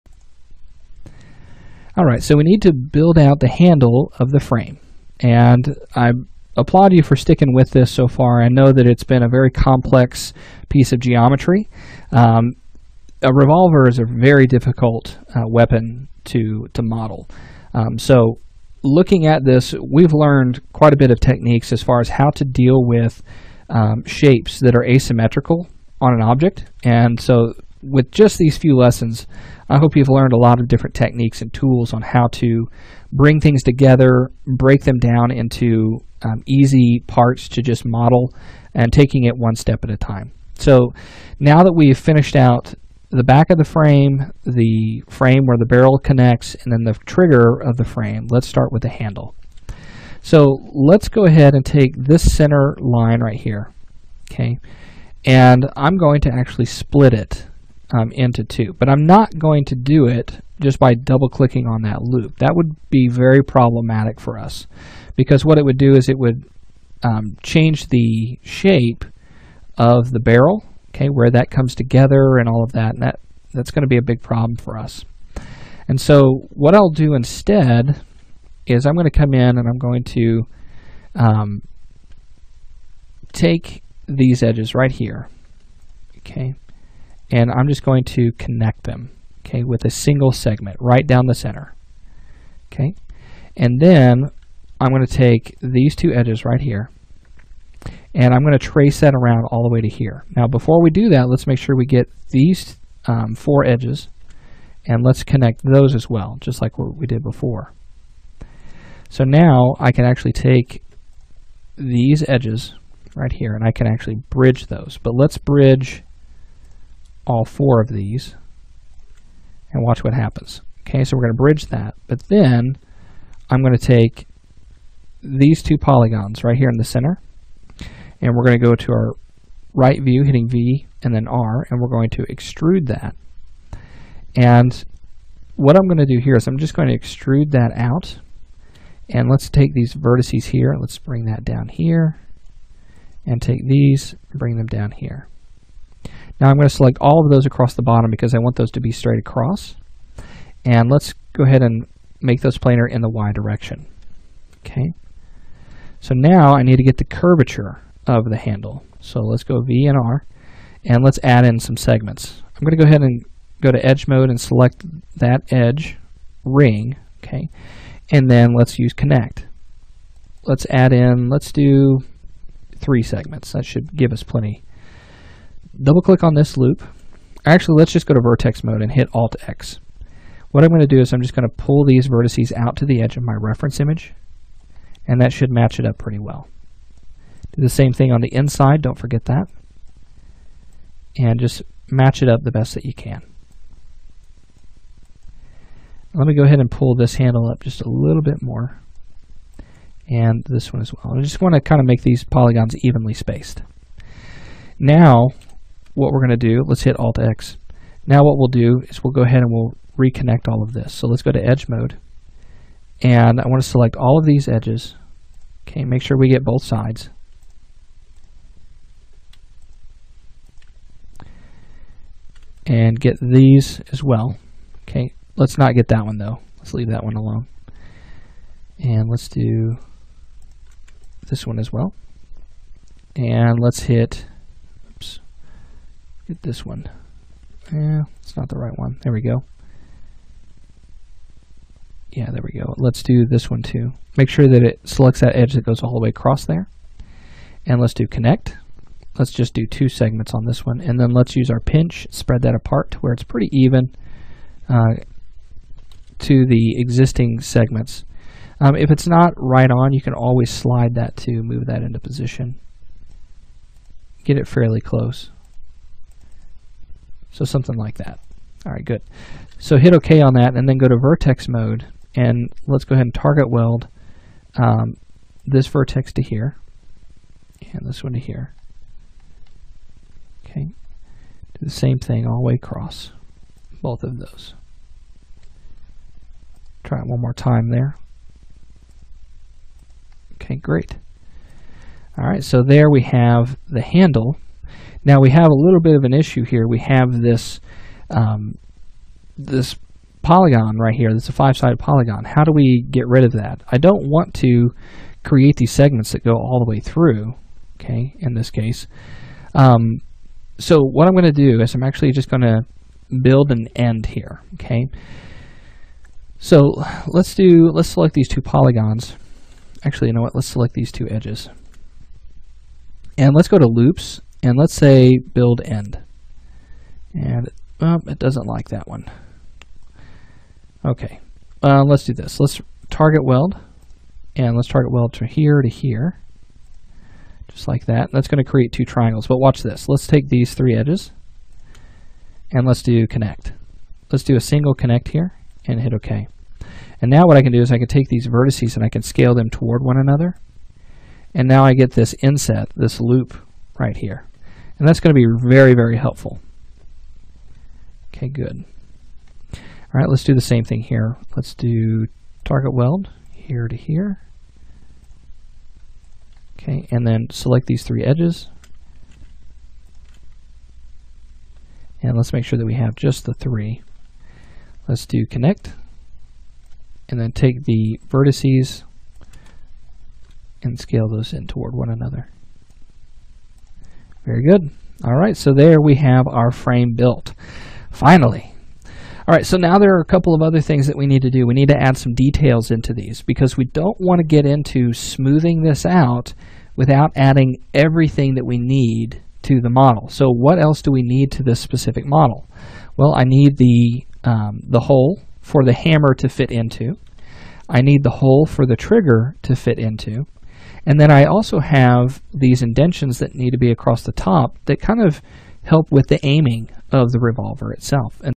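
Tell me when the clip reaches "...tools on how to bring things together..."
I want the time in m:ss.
0:31.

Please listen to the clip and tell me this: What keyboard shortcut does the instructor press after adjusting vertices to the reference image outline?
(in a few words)
Alt X.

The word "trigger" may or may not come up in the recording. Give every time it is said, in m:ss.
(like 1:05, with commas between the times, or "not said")
0:47, 6:48.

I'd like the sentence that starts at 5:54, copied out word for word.
And that's going to be very, very helpful.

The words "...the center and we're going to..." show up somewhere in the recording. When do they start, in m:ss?
2:06.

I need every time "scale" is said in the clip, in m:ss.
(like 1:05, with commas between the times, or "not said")
5:49, 6:20.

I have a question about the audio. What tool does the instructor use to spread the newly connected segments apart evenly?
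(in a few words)
pinch.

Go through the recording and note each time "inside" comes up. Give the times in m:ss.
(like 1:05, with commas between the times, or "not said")
3:08.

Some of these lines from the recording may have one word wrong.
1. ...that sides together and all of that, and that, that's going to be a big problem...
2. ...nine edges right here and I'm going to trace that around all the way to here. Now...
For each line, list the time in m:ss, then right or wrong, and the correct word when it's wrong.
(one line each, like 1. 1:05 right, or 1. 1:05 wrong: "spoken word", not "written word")
1. 1:11 wrong: "comes", not "sides"
2. 1:35 wrong: "two", not "nine".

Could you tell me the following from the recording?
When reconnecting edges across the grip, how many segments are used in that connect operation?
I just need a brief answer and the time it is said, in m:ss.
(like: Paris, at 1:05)
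2, at 4:09.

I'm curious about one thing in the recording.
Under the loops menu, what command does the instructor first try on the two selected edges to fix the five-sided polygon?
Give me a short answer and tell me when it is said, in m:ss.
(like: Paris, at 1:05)
build end, at 5:25.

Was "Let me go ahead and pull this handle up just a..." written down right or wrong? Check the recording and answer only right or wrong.
right.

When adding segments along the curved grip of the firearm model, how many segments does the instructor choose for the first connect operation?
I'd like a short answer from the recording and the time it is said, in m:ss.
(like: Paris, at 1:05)
3, at 2:52.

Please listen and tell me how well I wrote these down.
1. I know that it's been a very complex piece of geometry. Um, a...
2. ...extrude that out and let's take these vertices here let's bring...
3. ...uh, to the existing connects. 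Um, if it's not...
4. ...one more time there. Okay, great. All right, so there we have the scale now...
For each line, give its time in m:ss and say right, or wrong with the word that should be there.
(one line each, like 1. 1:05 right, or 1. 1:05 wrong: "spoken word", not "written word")
1. 0:08 right
2. 2:16 right
3. 4:14 wrong: "segments", not "connects"
4. 4:47 wrong: "handle", not "scale".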